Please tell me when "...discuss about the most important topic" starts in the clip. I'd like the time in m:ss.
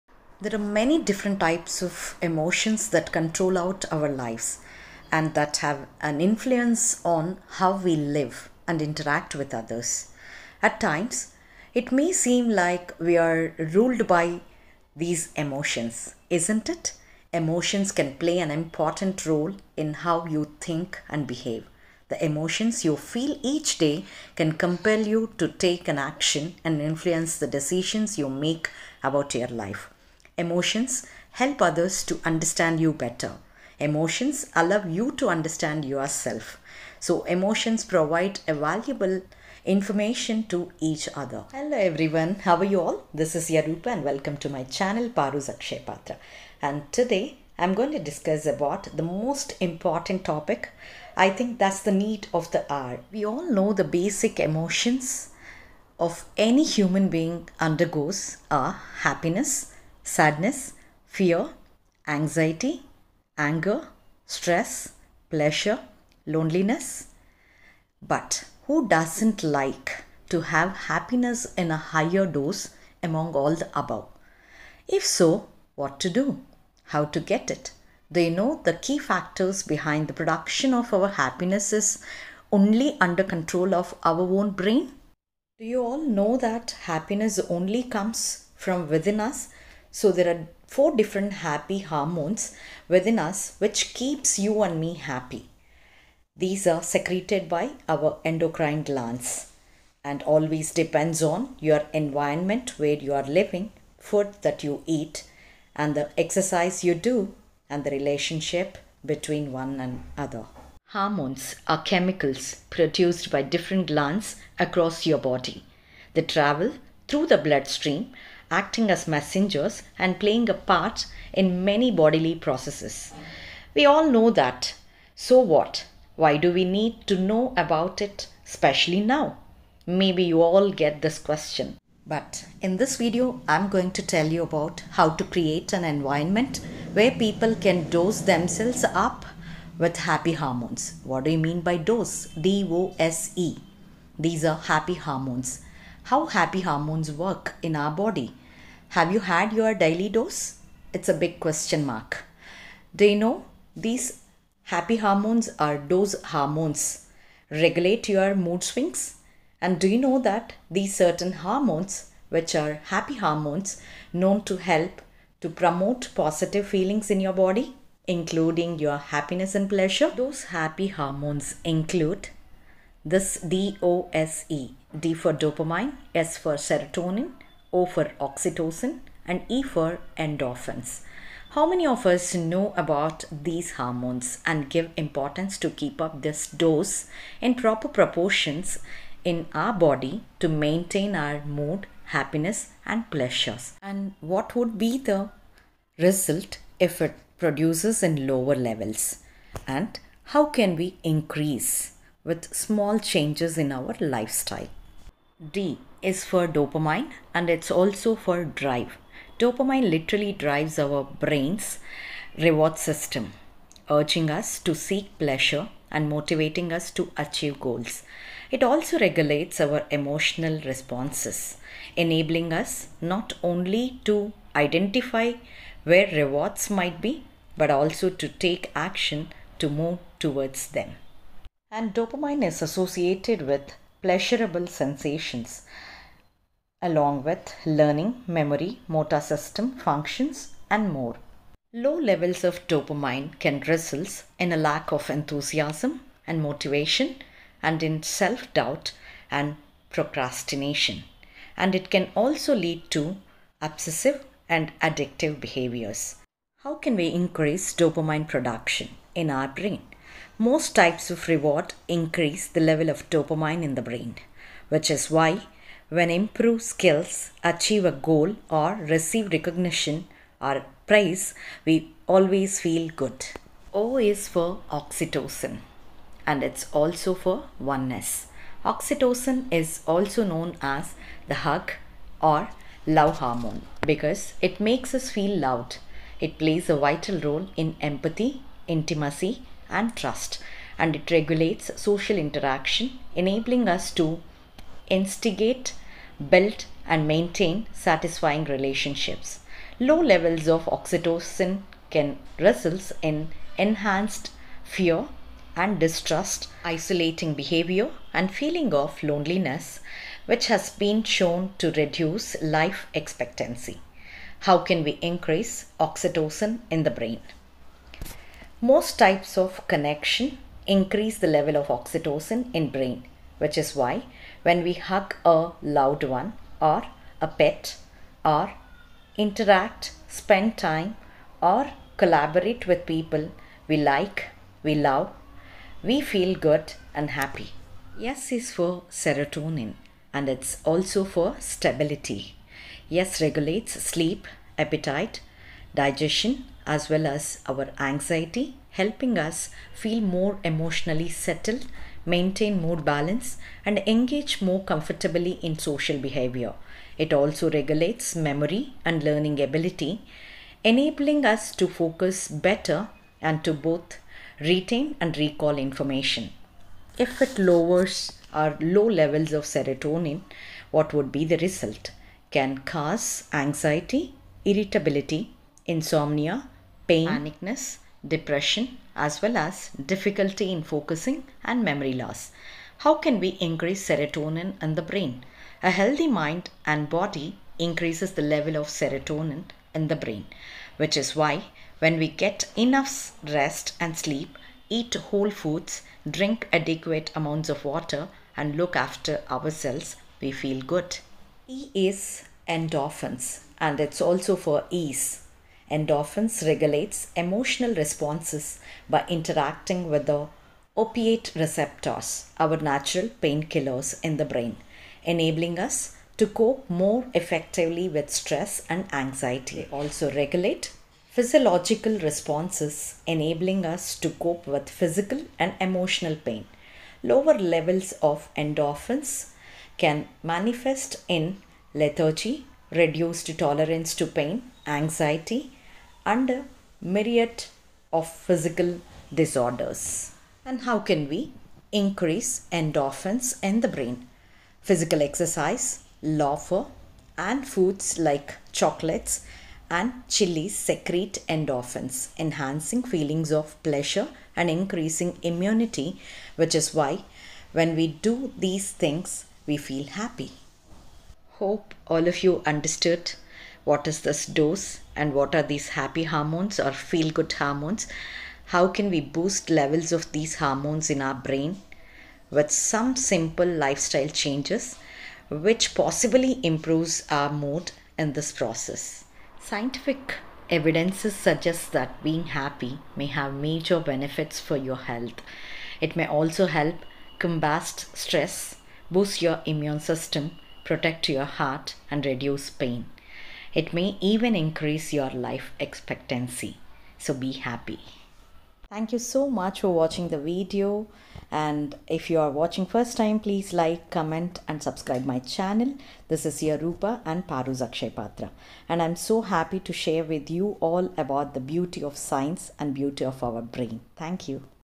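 0:47.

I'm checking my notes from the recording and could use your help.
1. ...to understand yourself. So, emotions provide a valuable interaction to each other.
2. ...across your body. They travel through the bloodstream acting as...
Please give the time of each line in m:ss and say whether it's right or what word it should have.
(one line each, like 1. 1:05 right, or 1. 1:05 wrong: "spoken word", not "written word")
1. 0:35 wrong: "information", not "interaction"
2. 1:54 right.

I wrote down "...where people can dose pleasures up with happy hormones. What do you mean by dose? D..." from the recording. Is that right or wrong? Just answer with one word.
wrong.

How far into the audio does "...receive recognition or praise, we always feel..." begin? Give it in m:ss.
4:28.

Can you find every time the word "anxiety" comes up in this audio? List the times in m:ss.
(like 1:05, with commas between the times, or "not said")
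1:02, 5:47, 6:13, 6:59, 7:14.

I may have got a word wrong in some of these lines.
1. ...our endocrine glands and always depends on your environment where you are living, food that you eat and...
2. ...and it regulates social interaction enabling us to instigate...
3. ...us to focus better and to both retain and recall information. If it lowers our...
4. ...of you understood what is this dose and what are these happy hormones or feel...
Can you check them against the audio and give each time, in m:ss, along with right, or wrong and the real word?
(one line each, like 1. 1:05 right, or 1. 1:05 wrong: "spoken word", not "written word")
1. 1:37 right
2. 4:50 right
3. 6:01 right
4. 7:42 right.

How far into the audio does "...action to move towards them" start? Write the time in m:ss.
3:48.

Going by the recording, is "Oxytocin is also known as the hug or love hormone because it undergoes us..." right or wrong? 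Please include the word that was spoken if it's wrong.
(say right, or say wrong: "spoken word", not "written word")
wrong: "makes", not "undergoes".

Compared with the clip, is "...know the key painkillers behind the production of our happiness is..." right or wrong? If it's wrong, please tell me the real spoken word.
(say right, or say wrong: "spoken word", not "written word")
wrong: "factors", not "painkillers".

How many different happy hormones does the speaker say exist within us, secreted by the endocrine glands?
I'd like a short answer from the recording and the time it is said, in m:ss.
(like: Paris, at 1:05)
4, at 1:30.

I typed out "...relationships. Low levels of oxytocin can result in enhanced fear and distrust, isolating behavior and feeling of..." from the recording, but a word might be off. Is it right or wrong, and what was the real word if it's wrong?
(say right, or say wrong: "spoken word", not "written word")
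right.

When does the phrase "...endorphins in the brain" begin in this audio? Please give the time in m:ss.
7:22.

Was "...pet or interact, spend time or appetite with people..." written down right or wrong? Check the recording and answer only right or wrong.
wrong.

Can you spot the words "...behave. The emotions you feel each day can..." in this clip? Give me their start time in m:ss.
0:21.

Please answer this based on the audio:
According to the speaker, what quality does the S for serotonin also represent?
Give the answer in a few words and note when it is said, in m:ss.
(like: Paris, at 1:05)
stability, at 5:41.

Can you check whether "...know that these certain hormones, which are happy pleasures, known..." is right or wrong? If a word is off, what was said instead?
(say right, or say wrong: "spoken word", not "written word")
wrong: "hormones", not "pleasures".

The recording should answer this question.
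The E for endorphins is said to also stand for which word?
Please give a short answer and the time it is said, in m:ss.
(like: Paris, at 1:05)
ease, at 6:44.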